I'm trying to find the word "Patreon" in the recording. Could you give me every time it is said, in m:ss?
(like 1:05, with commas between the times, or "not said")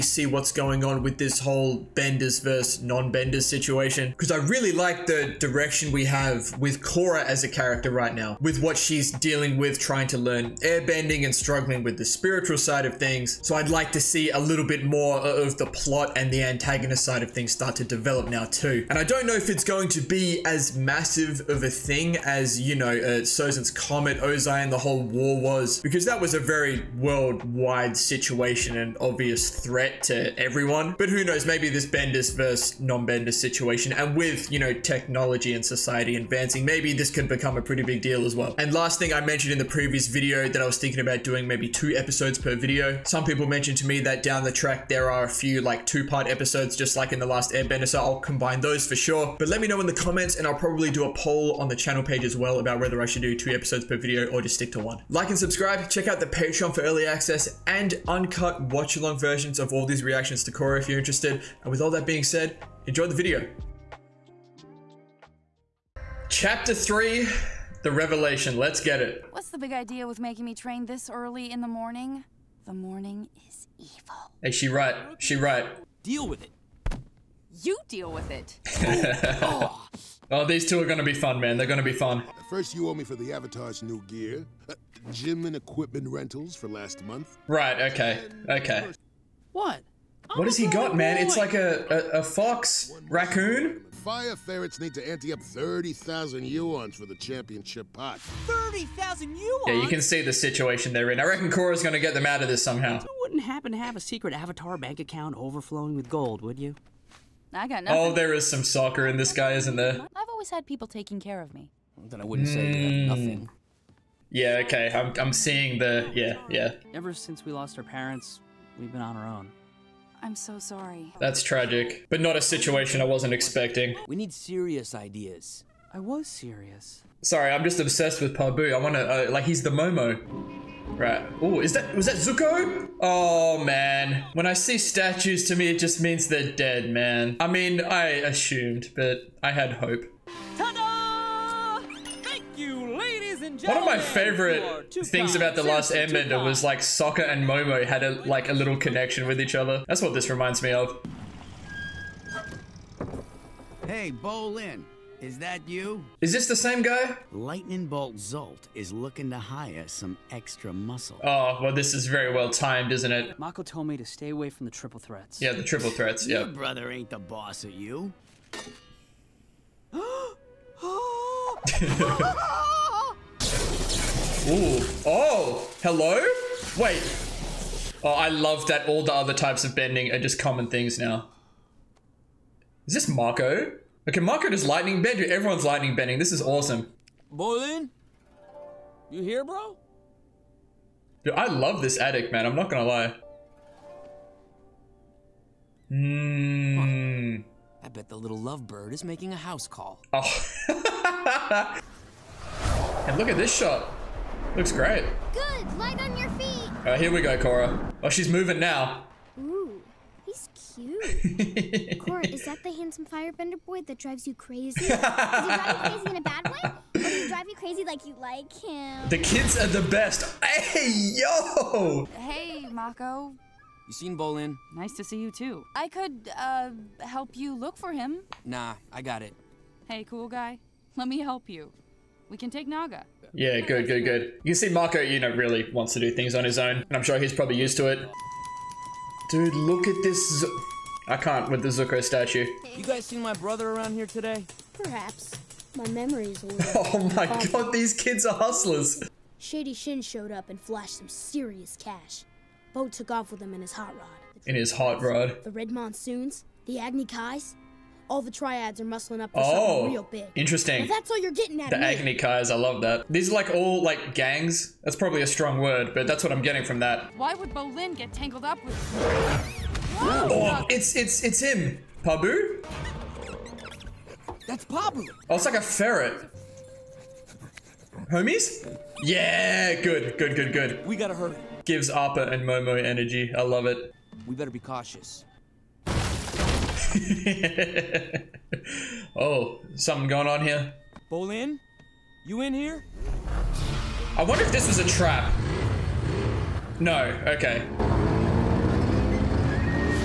0:56.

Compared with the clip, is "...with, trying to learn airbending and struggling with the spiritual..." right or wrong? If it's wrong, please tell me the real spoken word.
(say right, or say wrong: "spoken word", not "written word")
right.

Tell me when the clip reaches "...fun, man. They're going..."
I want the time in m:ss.
1:21.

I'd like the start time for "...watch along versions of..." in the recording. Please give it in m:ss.
0:58.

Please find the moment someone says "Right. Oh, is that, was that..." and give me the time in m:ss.
2:10.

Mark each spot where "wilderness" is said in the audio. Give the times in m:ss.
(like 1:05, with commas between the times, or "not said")
not said.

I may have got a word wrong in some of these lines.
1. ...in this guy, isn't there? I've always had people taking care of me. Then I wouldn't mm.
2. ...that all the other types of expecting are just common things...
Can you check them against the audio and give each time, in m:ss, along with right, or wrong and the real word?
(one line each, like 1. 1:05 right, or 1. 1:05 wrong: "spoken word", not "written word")
1. 1:49 right
2. 2:58 wrong: "bending", not "expecting".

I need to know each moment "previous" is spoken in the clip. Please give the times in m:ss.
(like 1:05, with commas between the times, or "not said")
0:39.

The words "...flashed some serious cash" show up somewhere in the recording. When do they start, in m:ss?
4:10.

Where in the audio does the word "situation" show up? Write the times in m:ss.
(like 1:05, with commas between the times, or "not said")
0:03, 0:27, 0:33, 1:40, 2:02.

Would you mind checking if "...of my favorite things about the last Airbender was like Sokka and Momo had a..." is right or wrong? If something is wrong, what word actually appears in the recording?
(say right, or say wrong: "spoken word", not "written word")
right.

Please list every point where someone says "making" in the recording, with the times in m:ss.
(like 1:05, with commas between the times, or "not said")
1:10, 3:19.